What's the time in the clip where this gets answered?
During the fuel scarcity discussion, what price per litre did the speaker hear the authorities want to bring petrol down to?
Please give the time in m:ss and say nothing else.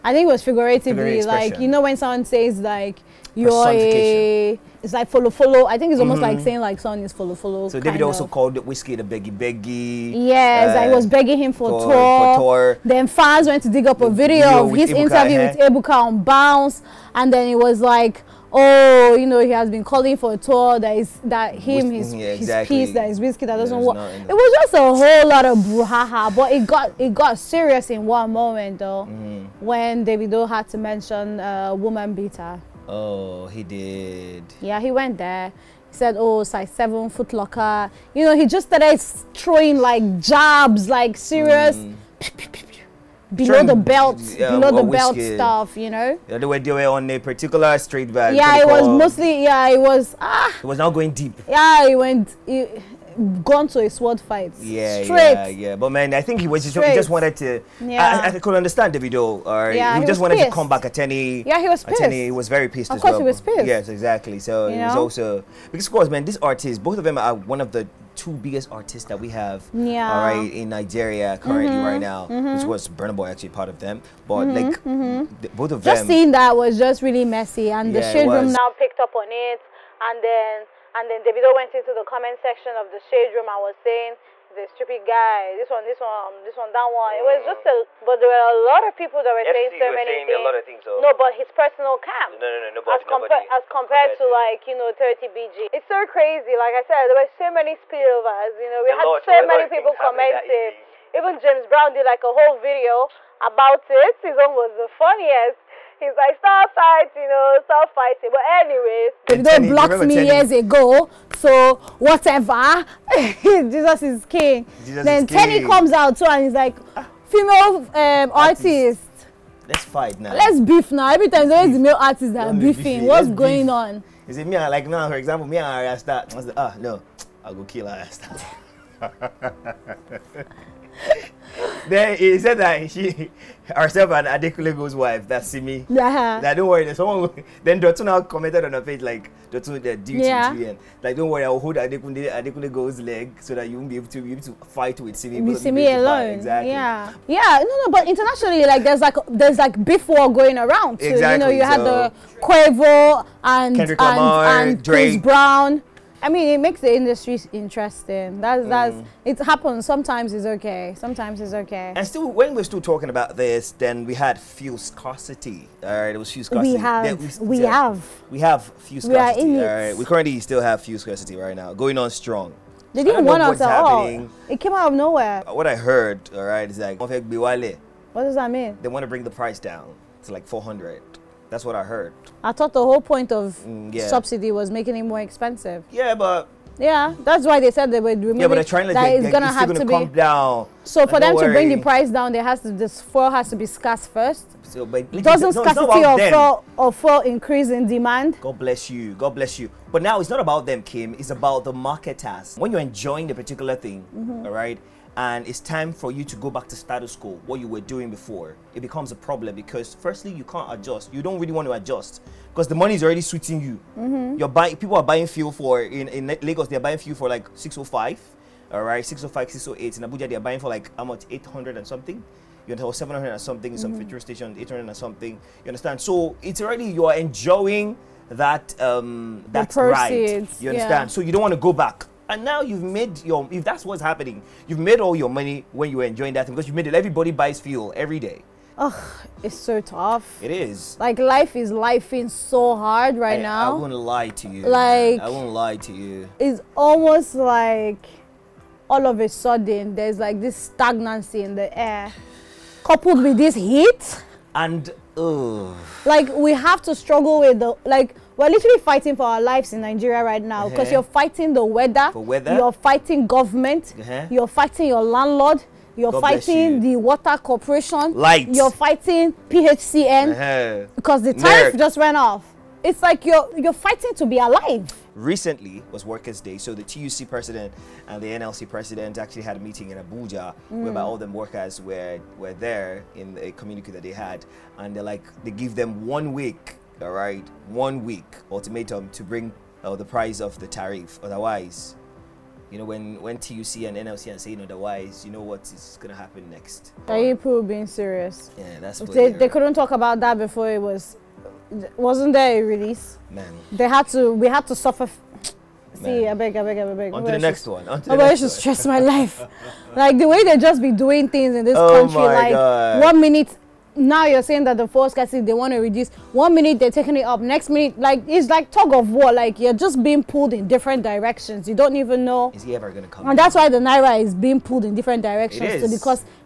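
3:00.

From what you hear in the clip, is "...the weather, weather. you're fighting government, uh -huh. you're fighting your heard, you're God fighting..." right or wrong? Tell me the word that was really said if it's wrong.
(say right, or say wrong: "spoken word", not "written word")
wrong: "landlord", not "heard".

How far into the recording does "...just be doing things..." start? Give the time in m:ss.
5:10.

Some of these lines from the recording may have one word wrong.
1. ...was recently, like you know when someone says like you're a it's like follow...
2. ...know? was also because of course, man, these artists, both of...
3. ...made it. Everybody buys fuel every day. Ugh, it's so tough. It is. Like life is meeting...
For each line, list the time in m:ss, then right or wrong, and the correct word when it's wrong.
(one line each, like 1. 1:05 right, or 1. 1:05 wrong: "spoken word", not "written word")
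1. 0:00 wrong: "figuratively", not "recently"
2. 1:04 right
3. 3:56 wrong: "lifeing", not "meeting".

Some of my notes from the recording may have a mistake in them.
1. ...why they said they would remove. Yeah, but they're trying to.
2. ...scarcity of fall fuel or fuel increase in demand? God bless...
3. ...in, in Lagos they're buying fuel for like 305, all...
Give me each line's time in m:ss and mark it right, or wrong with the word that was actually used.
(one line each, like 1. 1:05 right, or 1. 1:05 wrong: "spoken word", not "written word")
1. 3:07 right
2. 3:15 right
3. 3:35 wrong: "605", not "305".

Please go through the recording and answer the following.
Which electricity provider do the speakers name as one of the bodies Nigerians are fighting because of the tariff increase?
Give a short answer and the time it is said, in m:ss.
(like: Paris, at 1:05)
PHCN, at 4:29.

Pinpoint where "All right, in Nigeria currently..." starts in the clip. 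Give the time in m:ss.
1:10.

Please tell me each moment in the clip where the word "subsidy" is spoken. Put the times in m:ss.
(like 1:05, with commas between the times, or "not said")
3:04.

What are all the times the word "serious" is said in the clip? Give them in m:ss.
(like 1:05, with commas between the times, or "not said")
0:27, 0:41, 4:57.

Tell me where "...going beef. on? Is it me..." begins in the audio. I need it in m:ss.
2:03.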